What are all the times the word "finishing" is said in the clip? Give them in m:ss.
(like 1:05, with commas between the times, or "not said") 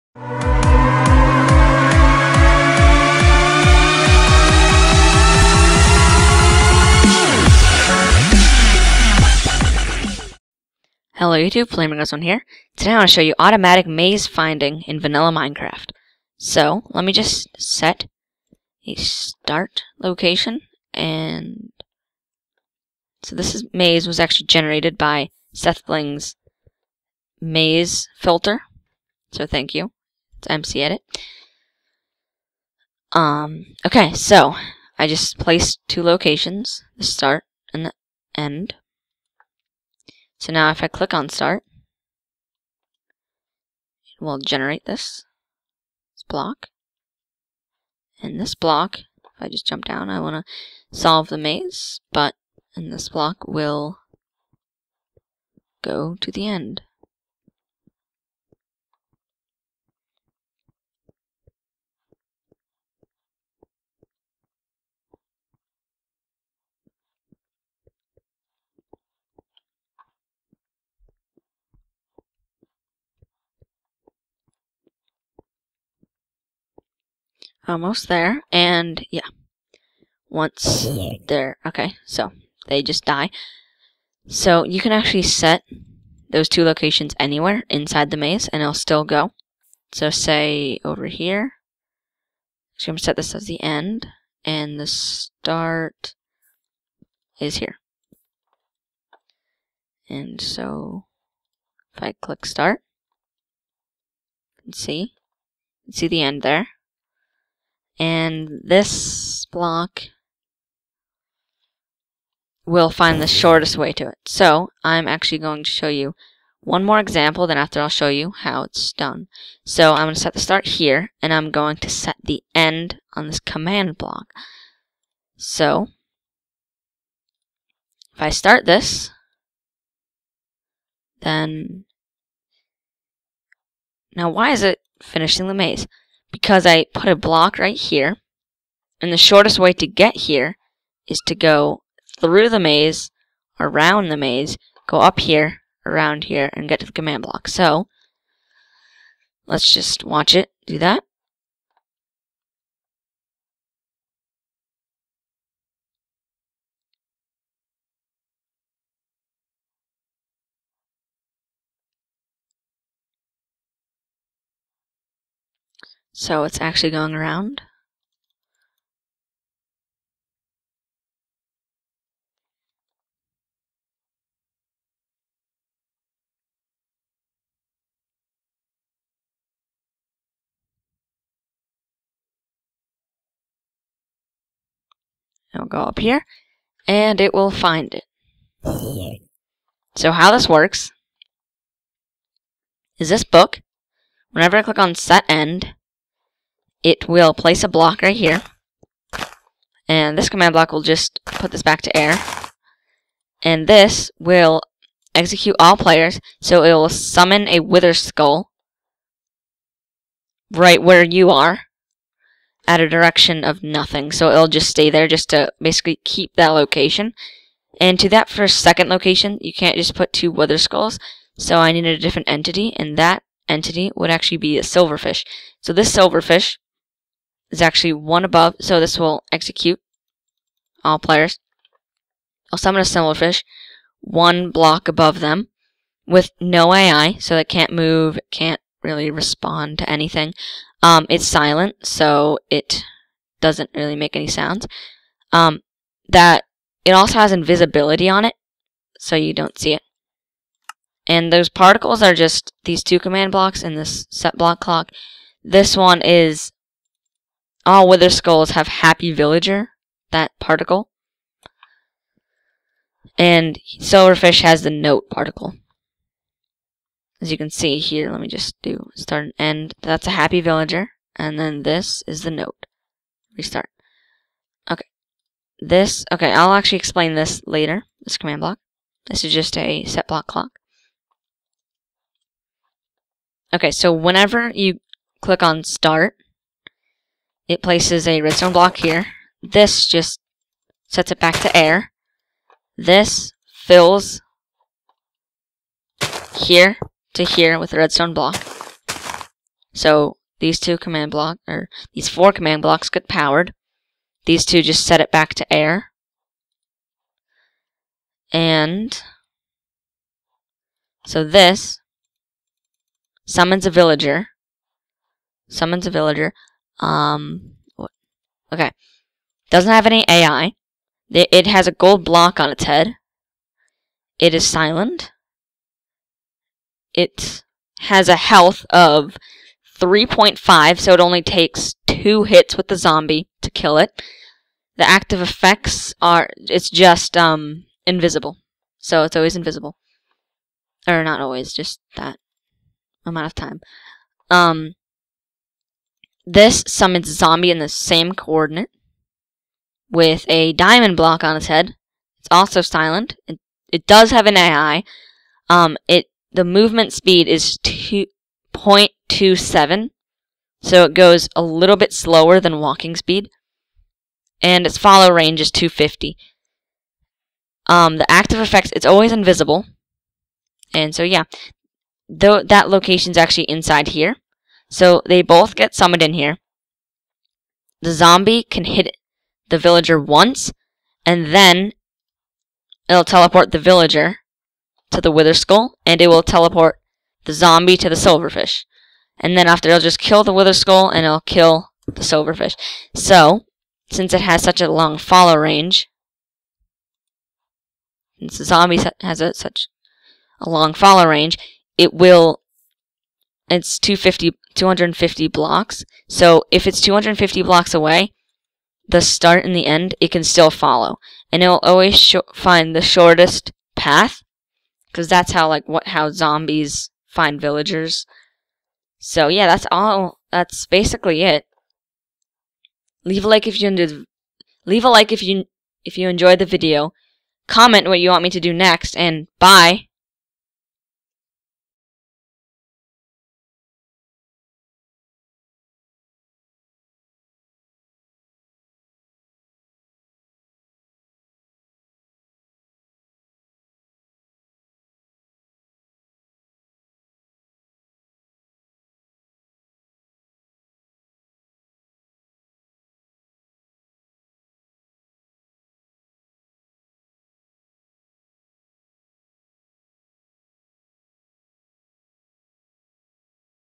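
2:15.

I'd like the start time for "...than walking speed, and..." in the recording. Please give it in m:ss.
6:02.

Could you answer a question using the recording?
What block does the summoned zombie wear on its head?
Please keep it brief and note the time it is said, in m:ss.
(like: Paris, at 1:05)
Diamond block, at 5:50.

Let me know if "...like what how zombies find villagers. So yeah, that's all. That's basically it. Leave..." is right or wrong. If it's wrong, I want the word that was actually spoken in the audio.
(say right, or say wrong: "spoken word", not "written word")
right.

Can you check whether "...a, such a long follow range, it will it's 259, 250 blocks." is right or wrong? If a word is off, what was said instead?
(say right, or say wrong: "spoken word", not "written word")
wrong: "250", not "259".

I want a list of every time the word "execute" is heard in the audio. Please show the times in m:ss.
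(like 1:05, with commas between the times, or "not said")
3:25, 3:49.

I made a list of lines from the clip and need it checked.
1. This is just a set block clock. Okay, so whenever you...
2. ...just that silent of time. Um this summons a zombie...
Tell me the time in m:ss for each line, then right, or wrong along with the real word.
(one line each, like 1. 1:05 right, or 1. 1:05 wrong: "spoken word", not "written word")
1. 4:39 right
2. 5:41 wrong: "amount", not "silent".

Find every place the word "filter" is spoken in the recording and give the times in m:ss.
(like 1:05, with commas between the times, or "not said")
0:28.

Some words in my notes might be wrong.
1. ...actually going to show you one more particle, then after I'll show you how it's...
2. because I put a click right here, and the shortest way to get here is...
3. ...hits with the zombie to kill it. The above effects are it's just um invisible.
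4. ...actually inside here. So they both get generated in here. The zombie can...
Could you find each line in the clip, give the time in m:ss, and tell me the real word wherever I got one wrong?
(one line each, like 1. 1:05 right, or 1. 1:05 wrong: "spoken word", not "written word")
1. 1:55 wrong: "example", not "particle"
2. 2:16 wrong: "block", not "click"
3. 5:32 wrong: "active", not "above"
4. 6:13 wrong: "summoned", not "generated".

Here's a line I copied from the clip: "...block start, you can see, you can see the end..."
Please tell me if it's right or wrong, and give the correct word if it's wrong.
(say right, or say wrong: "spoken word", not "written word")
wrong: "click", not "block".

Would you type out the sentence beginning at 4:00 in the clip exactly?
Um, it's silent, so it doesn't really make any sounds.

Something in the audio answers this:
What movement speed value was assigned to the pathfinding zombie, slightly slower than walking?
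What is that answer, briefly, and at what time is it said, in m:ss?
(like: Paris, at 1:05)
2.27, at 5:57.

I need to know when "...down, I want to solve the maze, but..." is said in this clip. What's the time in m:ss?
0:49.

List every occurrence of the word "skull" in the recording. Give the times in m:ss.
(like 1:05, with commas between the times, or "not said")
3:27, 3:40, 4:18, 6:25, 6:30.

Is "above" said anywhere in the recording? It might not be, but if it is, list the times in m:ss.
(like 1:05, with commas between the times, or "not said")
3:48, 3:54.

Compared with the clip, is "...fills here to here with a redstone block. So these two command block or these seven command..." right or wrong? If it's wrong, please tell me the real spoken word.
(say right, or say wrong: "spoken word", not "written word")
wrong: "four", not "seven".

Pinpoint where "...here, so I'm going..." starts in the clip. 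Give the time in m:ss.
1:31.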